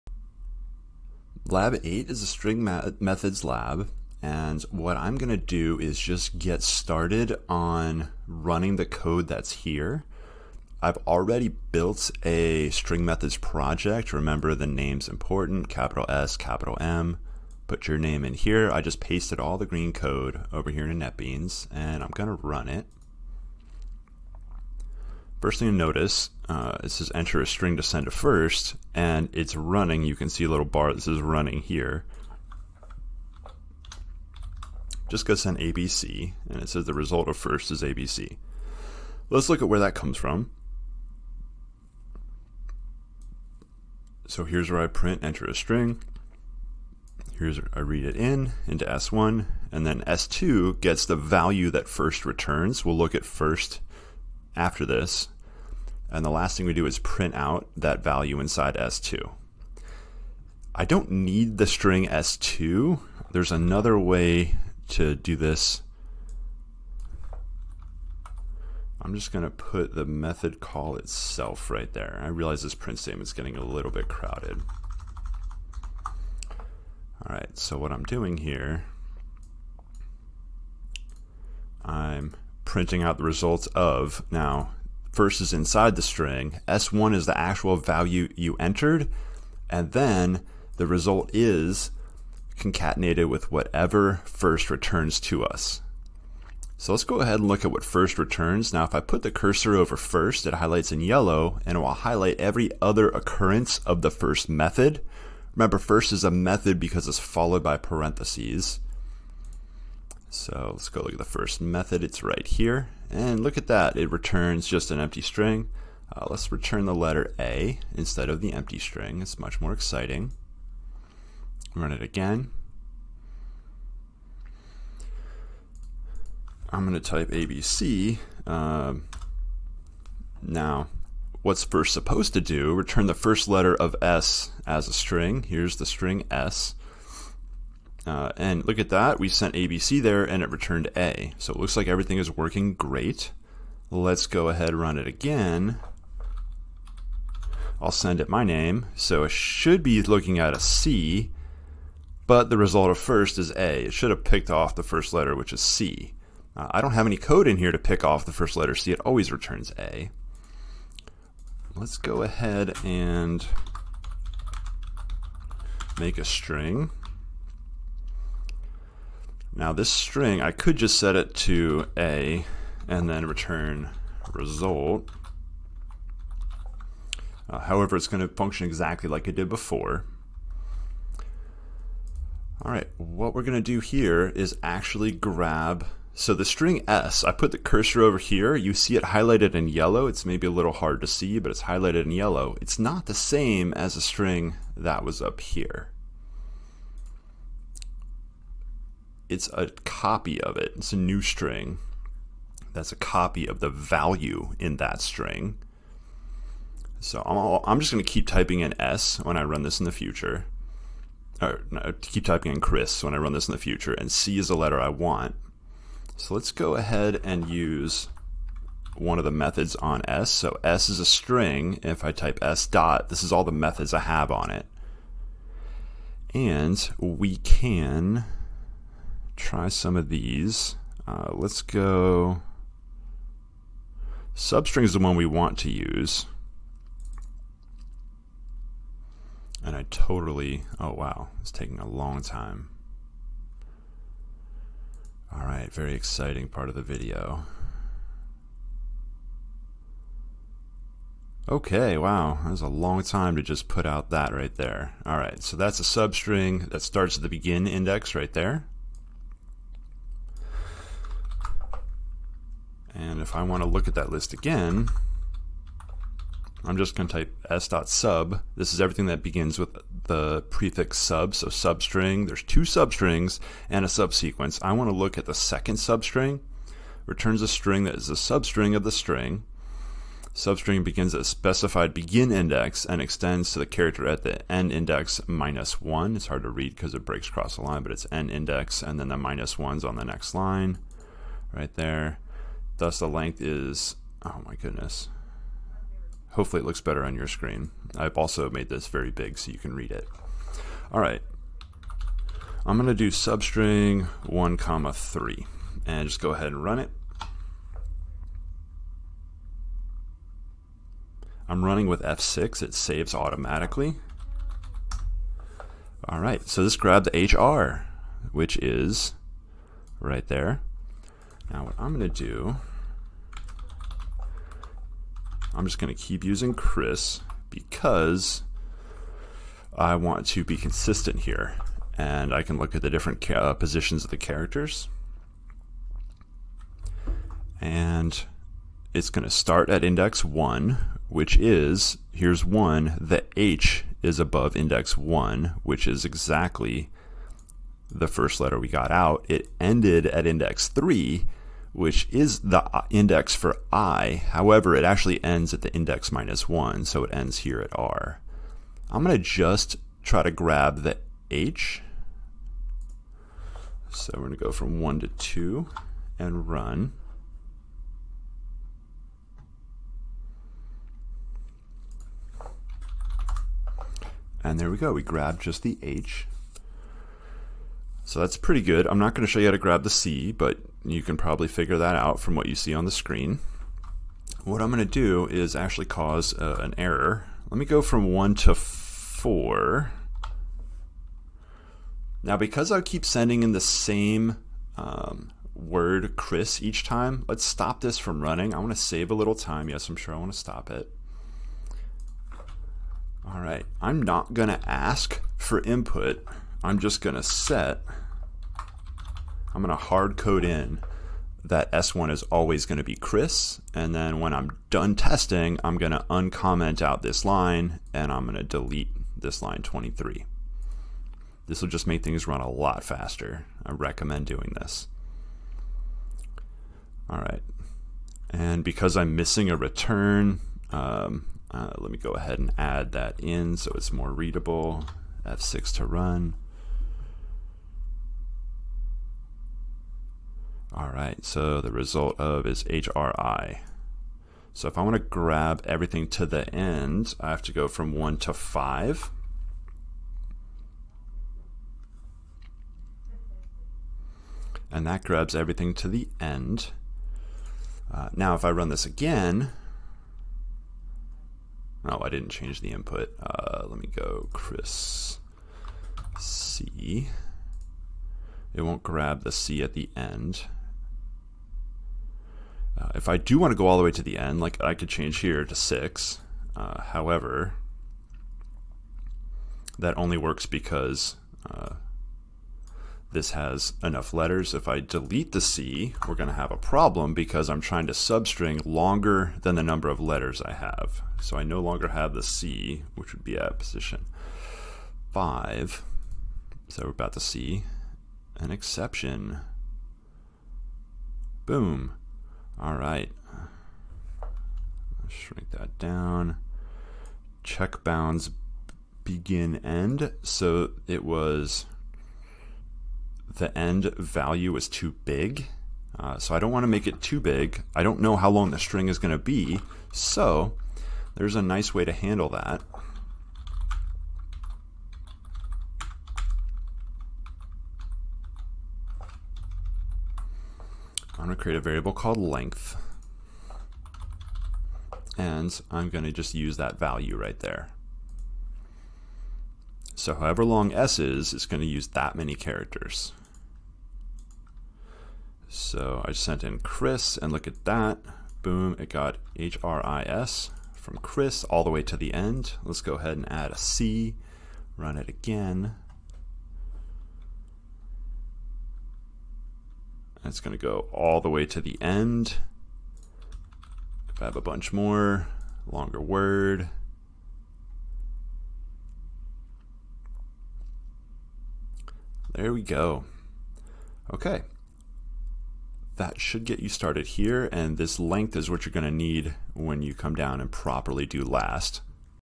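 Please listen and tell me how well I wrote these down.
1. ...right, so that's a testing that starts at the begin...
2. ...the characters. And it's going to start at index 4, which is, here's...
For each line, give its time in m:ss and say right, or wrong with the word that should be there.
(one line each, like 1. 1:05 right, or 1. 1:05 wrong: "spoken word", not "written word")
1. 4:15 wrong: "substring", not "testing"
2. 5:34 wrong: "1", not "4".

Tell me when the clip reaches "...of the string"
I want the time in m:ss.
4:38.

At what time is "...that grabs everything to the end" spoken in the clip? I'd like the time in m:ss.
7:34.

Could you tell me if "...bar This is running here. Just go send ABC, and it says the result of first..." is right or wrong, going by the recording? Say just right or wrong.
right.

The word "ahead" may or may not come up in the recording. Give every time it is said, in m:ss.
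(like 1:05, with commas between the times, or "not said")
1:37, 2:24, 2:42, 3:36, 5:06, 7:12, 9:12.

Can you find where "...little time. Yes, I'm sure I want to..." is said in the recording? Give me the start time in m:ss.
6:39.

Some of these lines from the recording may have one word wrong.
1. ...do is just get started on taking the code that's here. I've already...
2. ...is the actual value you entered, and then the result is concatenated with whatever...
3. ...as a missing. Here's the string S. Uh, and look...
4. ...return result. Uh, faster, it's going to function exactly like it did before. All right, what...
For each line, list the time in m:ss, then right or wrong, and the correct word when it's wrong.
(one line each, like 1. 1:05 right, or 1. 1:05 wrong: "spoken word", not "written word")
1. 0:05 wrong: "running", not "taking"
2. 1:27 right
3. 2:14 wrong: "string", not "missing"
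4. 2:53 wrong: "however", not "faster".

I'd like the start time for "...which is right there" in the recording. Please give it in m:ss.
5:18.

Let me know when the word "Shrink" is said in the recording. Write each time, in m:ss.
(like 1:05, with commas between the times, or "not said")
8:25.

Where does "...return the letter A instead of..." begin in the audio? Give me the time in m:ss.
1:56.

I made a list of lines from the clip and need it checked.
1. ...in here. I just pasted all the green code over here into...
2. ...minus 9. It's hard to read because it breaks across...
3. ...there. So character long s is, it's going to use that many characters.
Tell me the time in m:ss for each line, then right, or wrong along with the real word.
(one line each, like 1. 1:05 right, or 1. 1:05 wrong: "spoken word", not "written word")
1. 0:18 right
2. 4:45 wrong: "1", not "9"
3. 8:57 wrong: "however", not "character".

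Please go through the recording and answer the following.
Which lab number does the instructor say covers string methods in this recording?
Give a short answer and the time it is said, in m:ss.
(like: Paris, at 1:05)
8, at 0:01.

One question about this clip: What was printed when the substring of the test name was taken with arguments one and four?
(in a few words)
HRI.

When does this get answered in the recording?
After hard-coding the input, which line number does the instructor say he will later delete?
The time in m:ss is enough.
6:59.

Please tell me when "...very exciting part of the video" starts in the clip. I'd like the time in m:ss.
4:05.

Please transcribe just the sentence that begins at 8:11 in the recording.
So I no longer have the C, which would be at position 5.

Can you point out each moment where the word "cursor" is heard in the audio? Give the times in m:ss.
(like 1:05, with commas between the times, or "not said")
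1:39, 3:07.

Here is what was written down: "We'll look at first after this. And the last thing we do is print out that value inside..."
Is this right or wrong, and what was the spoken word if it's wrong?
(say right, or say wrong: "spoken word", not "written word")
right.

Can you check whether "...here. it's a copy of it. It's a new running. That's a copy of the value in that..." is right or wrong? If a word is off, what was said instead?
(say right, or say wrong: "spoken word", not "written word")
wrong: "string", not "running".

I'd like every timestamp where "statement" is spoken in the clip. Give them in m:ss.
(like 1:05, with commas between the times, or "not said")
1:12.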